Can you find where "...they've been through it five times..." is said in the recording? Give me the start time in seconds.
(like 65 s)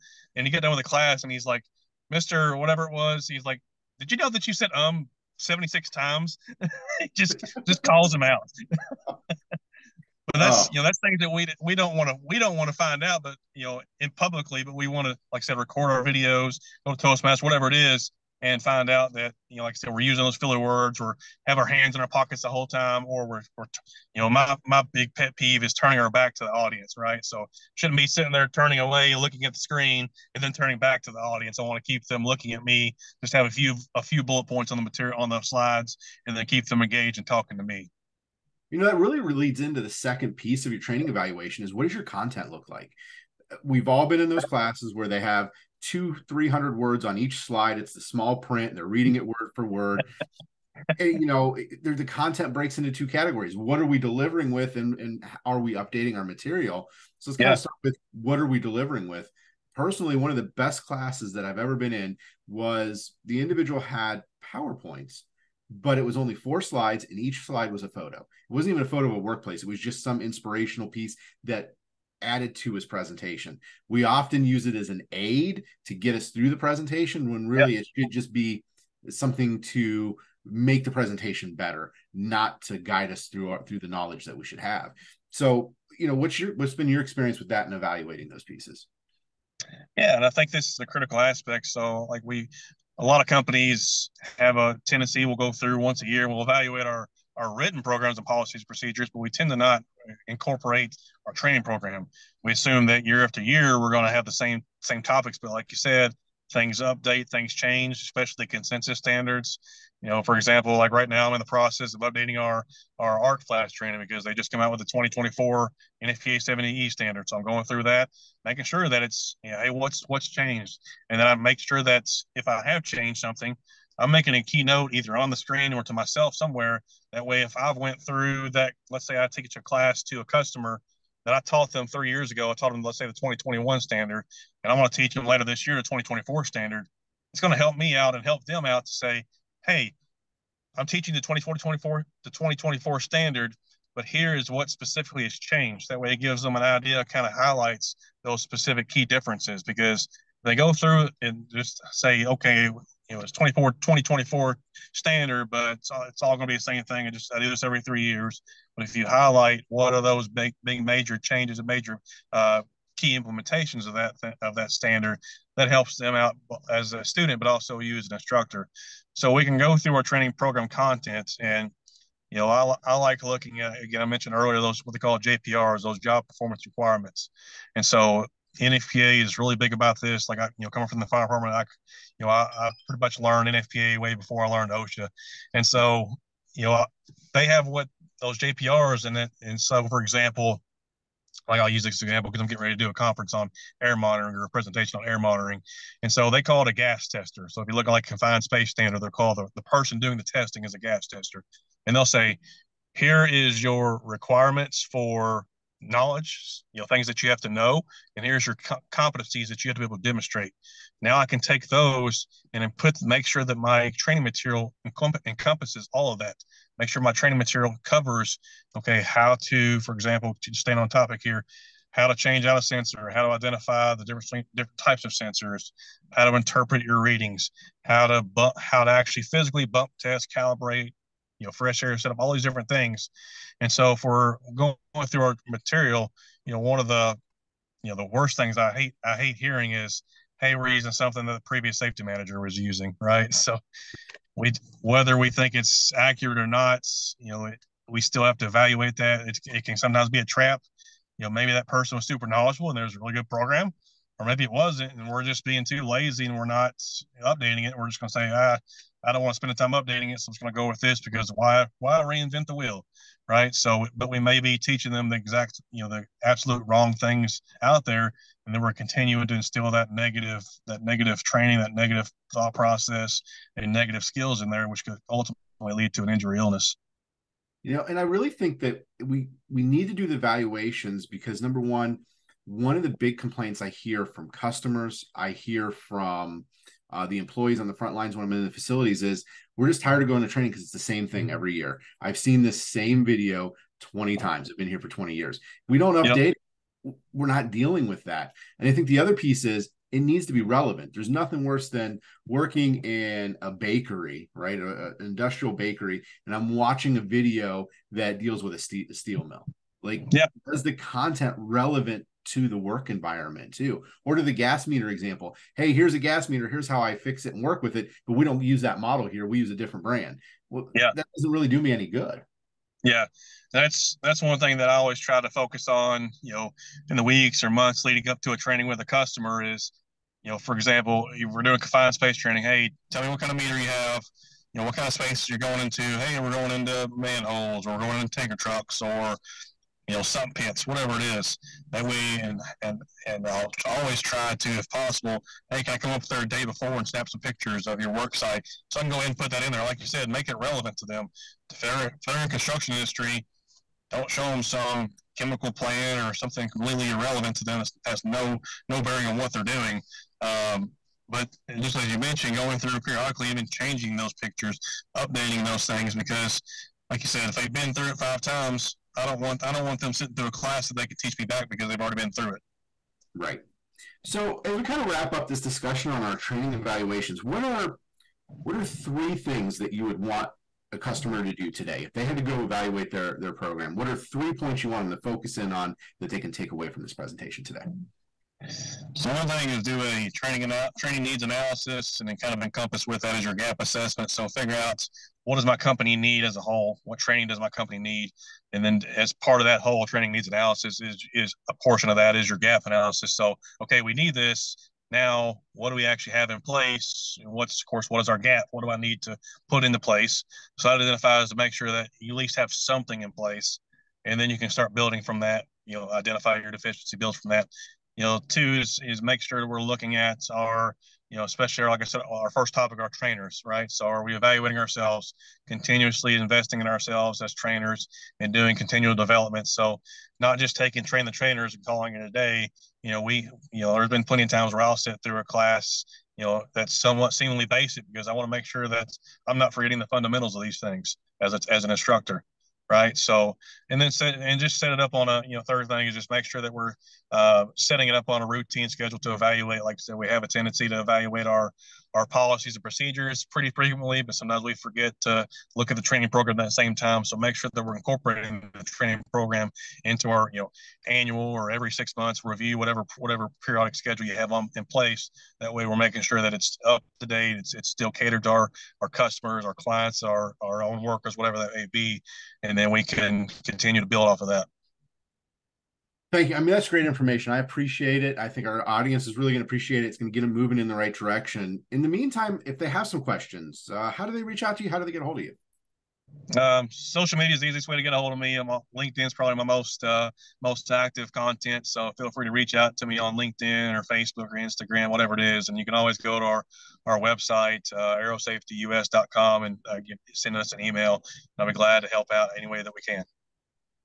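367 s.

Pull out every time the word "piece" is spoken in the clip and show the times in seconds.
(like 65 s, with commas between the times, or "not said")
40 s, 70 s, 88 s, 299 s.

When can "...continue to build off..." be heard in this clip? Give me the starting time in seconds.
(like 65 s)
473 s.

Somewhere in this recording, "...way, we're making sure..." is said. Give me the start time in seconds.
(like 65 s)
465 s.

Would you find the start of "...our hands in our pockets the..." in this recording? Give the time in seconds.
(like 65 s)
21 s.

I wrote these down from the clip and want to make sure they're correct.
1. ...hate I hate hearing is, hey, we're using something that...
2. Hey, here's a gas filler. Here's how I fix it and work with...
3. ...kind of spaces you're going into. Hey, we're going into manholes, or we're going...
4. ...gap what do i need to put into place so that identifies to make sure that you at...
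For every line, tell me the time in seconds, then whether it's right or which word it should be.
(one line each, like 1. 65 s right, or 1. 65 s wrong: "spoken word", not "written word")
1. 238 s right
2. 315 s wrong: "meter", not "filler"
3. 334 s right
4. 408 s right.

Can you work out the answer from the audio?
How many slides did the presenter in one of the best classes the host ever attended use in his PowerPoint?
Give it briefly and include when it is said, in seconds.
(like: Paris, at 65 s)
4, at 66 s.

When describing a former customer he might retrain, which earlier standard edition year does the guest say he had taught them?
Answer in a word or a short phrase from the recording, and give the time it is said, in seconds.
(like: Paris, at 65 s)
2021, at 133 s.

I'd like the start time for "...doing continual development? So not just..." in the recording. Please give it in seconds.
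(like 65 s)
428 s.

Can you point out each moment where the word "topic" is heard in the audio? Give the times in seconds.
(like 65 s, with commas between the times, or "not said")
105 s, 220 s, 422 s.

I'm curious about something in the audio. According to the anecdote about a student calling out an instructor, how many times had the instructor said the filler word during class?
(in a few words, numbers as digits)
76.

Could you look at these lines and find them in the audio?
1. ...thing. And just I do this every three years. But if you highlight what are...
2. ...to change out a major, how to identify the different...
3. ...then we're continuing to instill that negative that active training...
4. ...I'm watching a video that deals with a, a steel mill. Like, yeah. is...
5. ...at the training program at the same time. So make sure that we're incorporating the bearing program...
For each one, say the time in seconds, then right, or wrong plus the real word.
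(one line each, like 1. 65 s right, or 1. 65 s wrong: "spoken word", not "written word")
1. 156 s right
2. 222 s wrong: "sensor", not "major"
3. 268 s wrong: "negative", not "active"
4. 306 s right
5. 455 s wrong: "training", not "bearing".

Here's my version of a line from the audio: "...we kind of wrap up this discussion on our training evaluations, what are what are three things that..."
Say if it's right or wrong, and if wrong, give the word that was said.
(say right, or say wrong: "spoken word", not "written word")
right.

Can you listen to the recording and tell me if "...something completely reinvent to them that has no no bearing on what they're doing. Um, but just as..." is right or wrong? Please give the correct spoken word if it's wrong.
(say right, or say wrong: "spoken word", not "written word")
wrong: "irrelevant", not "reinvent".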